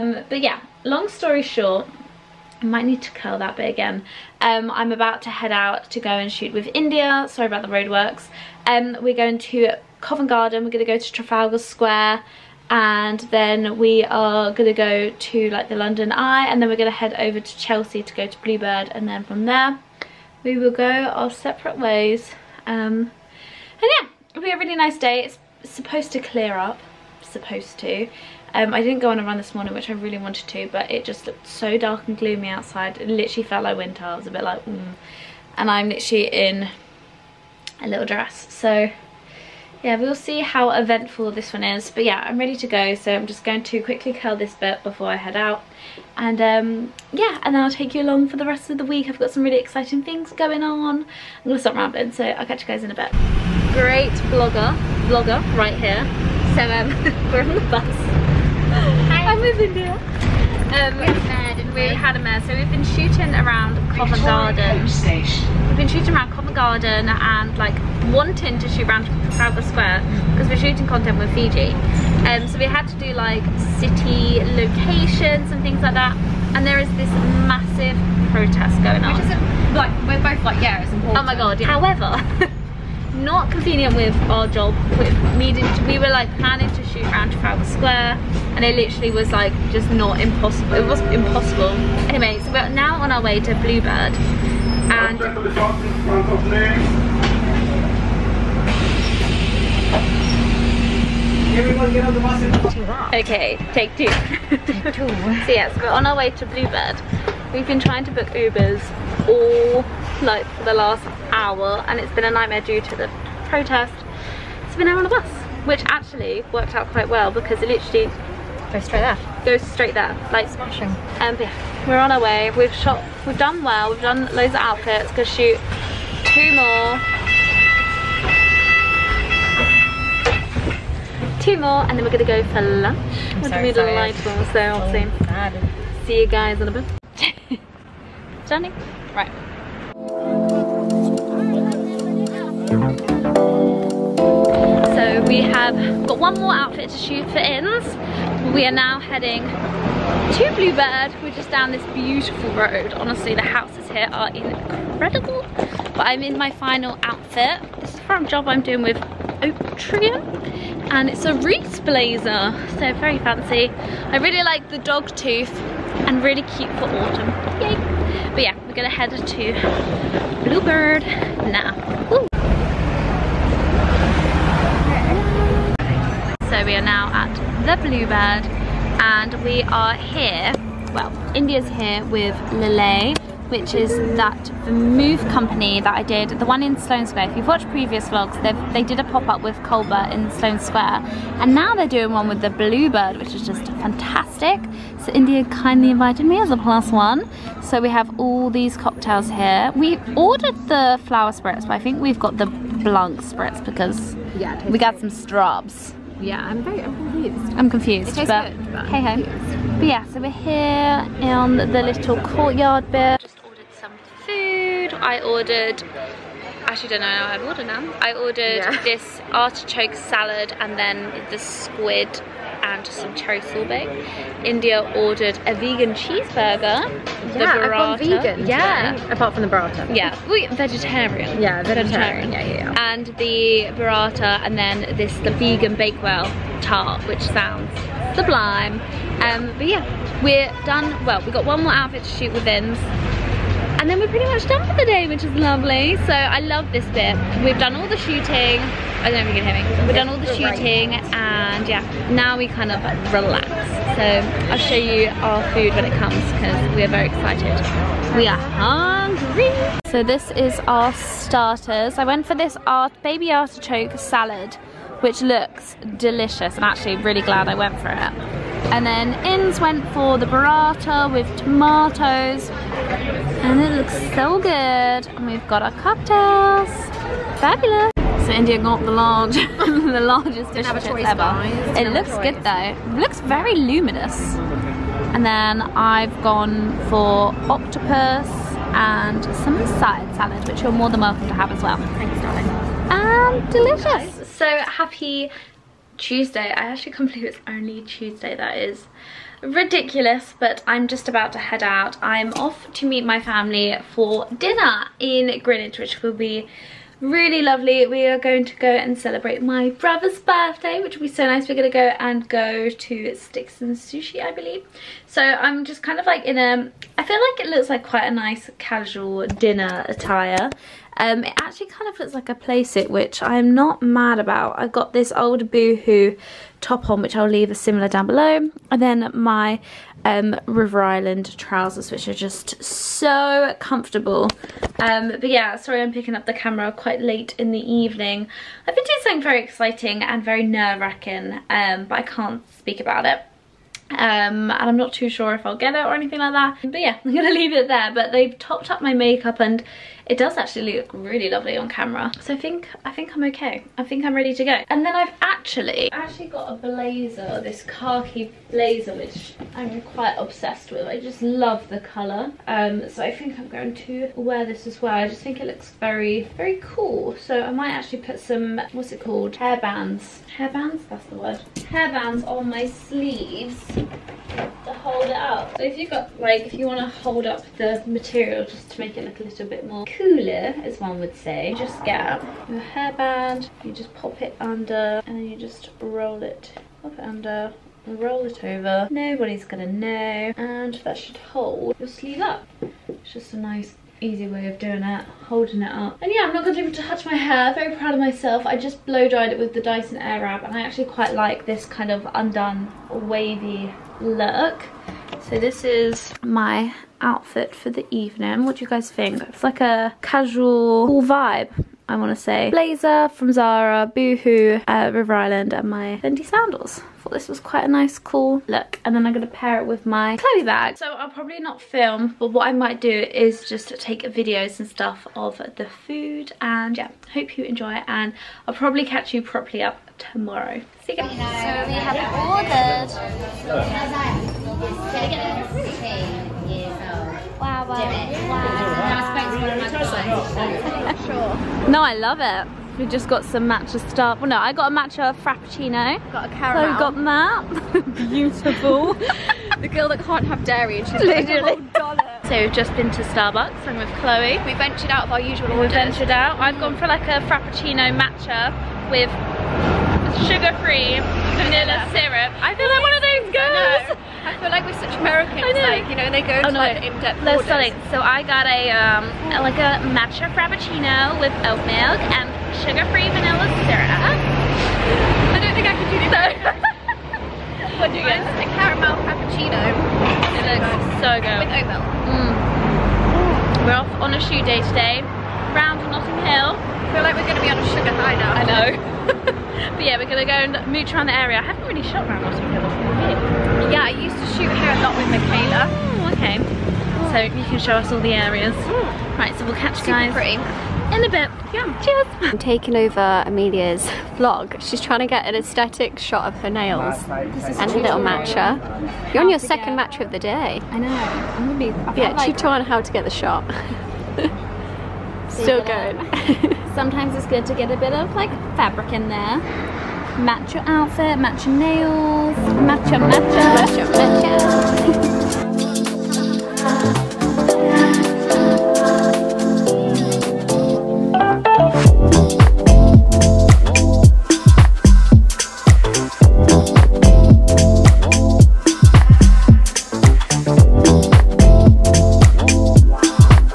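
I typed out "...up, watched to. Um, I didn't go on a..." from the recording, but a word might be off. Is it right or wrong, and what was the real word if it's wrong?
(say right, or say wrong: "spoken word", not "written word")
wrong: "supposed", not "watched".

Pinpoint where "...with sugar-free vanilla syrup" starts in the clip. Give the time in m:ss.
7:38.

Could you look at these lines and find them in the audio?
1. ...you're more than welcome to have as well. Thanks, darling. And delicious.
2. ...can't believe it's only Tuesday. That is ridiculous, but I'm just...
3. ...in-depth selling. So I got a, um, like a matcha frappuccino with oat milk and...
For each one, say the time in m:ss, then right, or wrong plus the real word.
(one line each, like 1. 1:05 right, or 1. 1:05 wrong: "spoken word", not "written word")
1. 4:50 right
2. 4:56 right
3. 7:46 right.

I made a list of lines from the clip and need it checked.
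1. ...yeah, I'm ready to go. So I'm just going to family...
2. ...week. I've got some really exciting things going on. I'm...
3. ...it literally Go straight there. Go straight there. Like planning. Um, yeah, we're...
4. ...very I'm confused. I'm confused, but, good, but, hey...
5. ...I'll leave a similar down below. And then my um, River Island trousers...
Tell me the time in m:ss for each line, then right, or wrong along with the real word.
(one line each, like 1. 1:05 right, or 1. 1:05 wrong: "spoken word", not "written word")
1. 0:42 wrong: "quickly", not "family"
2. 0:48 right
3. 1:57 wrong: "smashing", not "planning"
4. 3:26 right
5. 5:27 right.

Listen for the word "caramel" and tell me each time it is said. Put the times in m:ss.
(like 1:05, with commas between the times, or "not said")
7:26, 7:58.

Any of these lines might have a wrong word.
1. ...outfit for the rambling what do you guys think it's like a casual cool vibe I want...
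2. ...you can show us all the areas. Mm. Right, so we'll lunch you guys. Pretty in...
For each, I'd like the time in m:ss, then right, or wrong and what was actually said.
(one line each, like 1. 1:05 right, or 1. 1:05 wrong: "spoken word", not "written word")
1. 6:46 wrong: "evening", not "rambling"
2. 8:17 wrong: "catch", not "lunch".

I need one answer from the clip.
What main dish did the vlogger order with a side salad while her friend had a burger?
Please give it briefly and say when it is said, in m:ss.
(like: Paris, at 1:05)
octopus, at 4:47.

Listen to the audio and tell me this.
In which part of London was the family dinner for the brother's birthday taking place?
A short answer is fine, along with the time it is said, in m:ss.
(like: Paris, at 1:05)
Greenwich, at 5:05.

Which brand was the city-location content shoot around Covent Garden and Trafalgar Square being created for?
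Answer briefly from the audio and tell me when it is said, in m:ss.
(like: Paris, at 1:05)
Fiji, at 1:11.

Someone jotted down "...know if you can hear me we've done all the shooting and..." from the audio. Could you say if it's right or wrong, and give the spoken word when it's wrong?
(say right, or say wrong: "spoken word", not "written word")
right.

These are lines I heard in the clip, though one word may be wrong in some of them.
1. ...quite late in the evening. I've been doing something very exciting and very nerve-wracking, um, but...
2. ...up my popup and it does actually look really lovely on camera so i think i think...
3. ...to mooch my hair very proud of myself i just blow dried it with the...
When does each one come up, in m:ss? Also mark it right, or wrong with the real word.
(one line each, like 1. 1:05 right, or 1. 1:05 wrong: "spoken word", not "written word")
1. 5:36 right
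2. 5:48 wrong: "makeup", not "popup"
3. 6:36 wrong: "touch", not "mooch".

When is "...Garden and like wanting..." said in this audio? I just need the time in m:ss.
1:06.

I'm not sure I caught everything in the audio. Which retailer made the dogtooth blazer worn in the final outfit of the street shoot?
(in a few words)
Reiss.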